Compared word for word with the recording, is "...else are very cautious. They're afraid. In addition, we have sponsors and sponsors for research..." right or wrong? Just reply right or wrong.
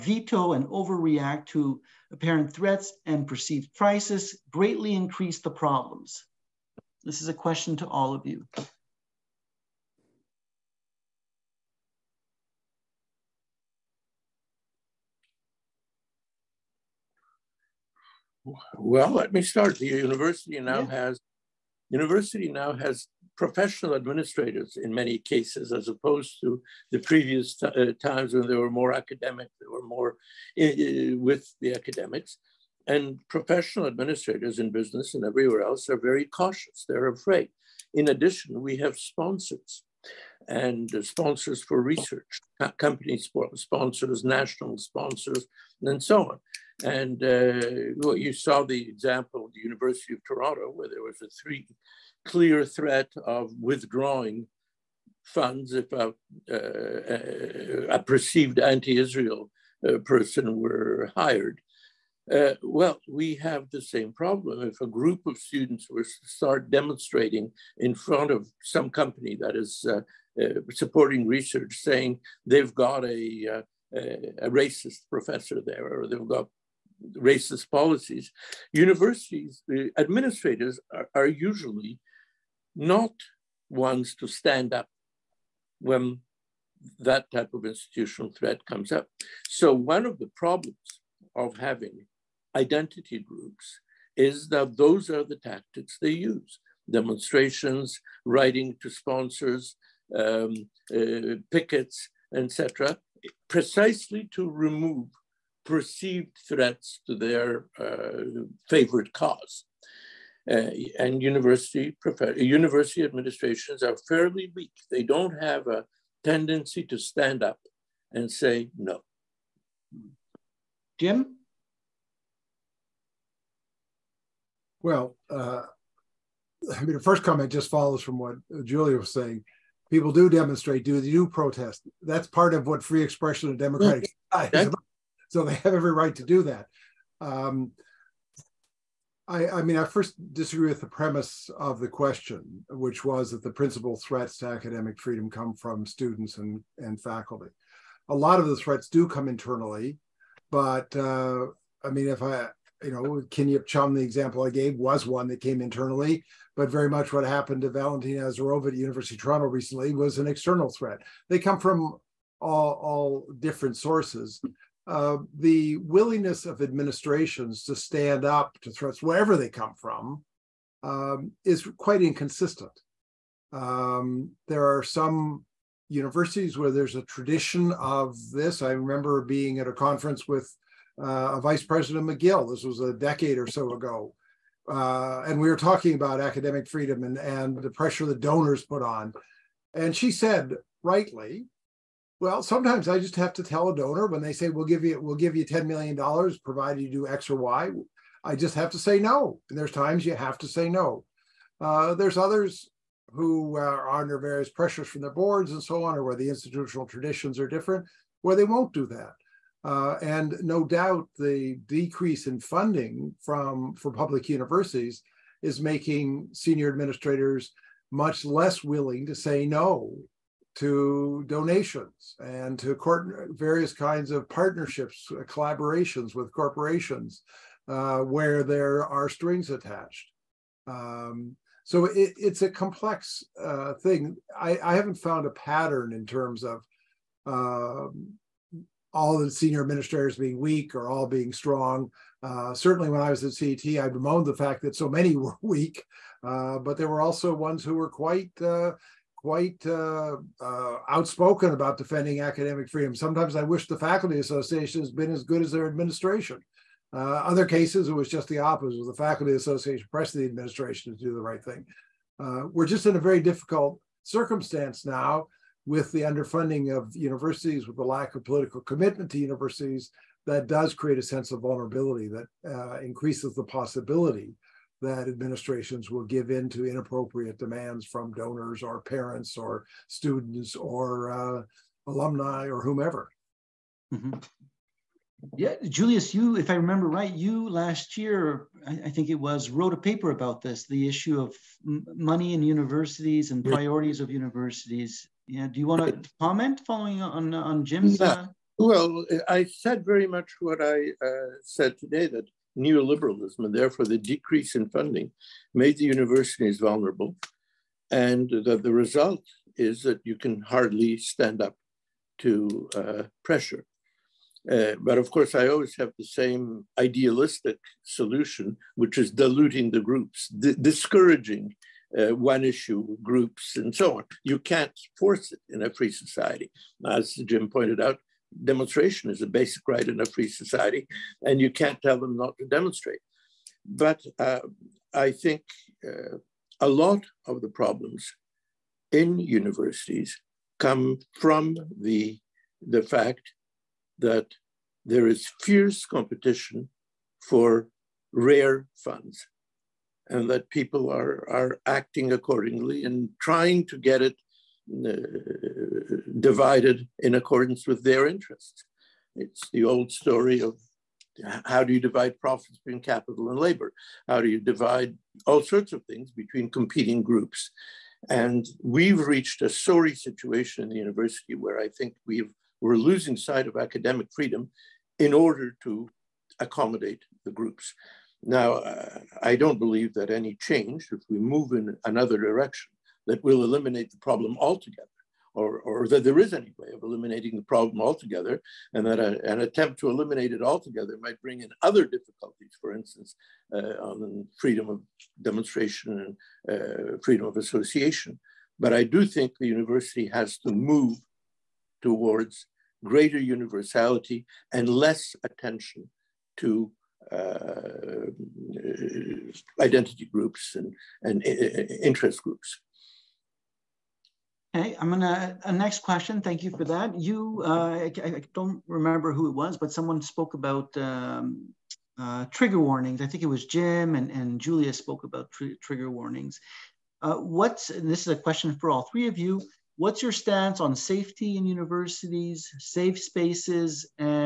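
right.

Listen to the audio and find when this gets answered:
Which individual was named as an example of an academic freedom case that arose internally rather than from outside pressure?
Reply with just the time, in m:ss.
2:33.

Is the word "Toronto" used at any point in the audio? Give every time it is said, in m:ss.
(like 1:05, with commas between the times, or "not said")
0:50, 2:39.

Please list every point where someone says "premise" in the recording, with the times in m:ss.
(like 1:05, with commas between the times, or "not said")
2:20.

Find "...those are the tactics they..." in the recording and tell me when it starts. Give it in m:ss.
1:34.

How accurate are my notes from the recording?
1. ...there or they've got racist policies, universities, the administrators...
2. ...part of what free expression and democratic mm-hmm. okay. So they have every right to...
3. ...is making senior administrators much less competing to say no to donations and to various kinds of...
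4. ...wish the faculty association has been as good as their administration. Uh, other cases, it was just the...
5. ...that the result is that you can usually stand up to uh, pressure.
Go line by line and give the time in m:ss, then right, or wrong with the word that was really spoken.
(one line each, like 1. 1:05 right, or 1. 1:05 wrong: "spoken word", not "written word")
1. 1:15 right
2. 2:12 right
3. 3:35 wrong: "willing", not "competing"
4. 4:13 right
5. 5:08 wrong: "hardly", not "usually".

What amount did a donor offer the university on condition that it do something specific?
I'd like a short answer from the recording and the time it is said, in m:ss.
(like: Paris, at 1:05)
ten million dollars, at 3:15.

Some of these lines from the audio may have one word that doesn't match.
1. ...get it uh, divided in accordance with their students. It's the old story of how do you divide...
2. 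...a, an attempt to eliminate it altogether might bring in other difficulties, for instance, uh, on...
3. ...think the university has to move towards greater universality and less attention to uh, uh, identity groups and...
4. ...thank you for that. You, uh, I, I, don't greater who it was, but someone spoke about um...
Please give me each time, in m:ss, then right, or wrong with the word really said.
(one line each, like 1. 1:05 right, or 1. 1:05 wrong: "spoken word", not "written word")
1. 5:53 wrong: "interests", not "students"
2. 6:28 right
3. 6:39 right
4. 6:56 wrong: "remember", not "greater".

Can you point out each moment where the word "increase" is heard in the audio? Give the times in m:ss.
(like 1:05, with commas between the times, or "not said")
0:04, 4:32.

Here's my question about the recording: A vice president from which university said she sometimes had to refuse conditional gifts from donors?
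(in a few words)
McGill.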